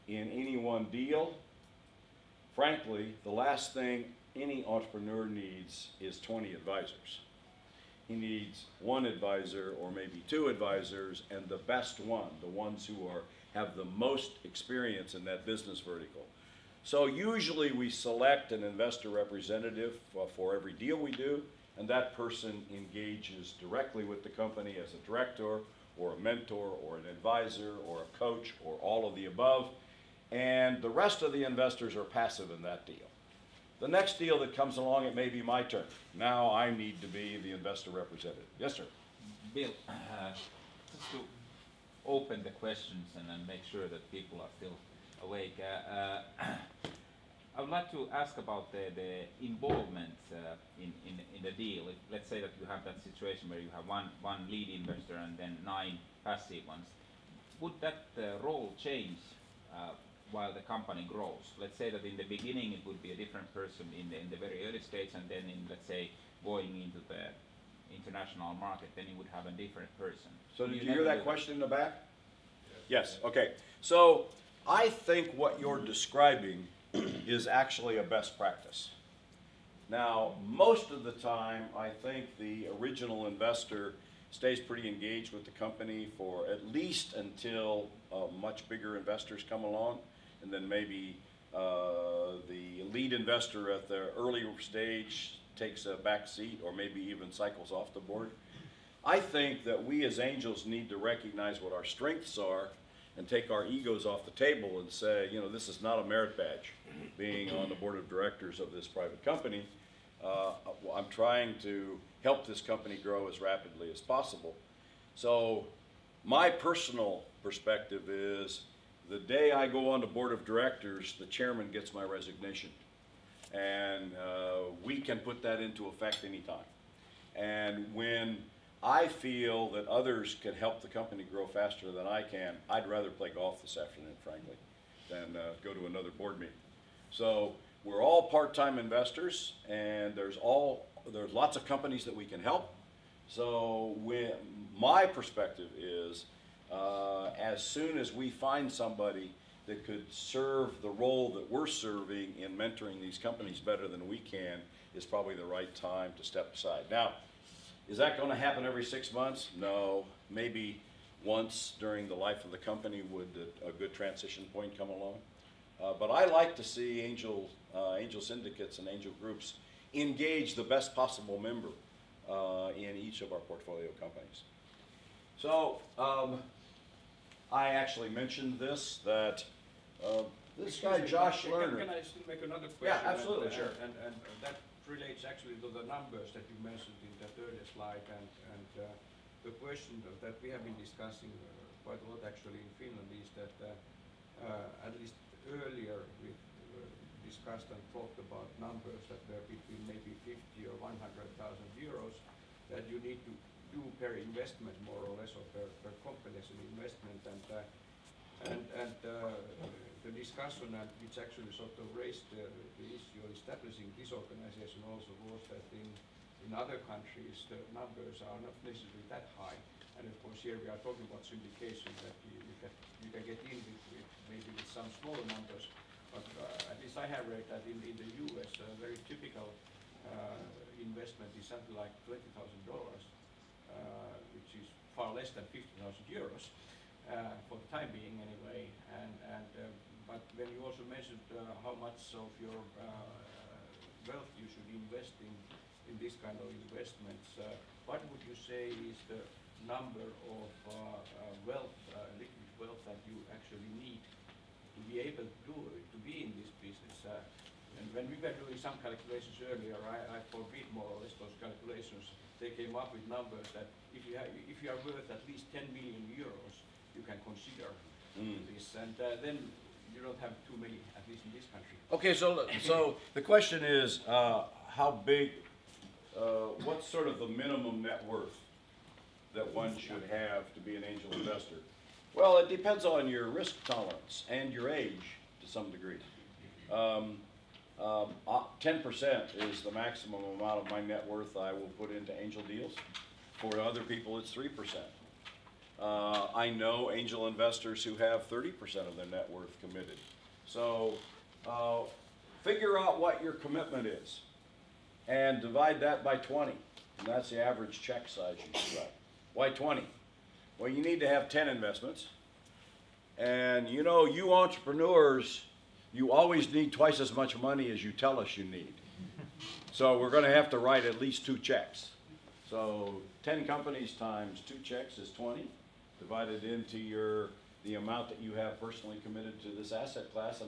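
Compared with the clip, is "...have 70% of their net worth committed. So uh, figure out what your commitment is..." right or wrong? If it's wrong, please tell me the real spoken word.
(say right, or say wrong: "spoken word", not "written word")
wrong: "30", not "70".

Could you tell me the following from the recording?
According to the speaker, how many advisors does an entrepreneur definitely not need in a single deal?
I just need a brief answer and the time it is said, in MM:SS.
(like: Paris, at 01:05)
20 advisors, at 00:06.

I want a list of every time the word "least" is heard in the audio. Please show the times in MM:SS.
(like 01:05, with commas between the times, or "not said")
01:26, 03:15, 03:46, 04:25, 04:31, 05:20.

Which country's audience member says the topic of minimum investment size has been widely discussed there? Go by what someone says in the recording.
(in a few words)
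Finland.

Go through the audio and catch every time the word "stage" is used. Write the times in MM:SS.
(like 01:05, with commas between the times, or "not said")
01:04, 01:34.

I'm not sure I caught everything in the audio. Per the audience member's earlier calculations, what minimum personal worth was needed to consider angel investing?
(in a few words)
10 million euros.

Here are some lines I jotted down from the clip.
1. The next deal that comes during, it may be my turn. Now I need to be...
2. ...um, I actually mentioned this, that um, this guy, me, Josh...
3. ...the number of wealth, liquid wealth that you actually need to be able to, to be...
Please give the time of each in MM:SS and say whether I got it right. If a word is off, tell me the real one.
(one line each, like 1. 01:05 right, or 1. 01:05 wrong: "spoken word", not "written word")
1. 00:33 wrong: "along", not "during"
2. 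02:55 right
3. 04:09 right.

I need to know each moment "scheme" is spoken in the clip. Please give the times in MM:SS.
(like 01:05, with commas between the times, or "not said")
not said.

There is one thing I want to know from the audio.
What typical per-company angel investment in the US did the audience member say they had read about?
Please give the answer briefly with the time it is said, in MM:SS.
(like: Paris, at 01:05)
$20,000, at 03:52.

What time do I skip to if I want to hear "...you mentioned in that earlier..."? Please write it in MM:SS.
03:06.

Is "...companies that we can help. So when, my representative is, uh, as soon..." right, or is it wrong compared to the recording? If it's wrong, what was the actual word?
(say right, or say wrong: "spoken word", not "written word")
wrong: "perspective", not "representative".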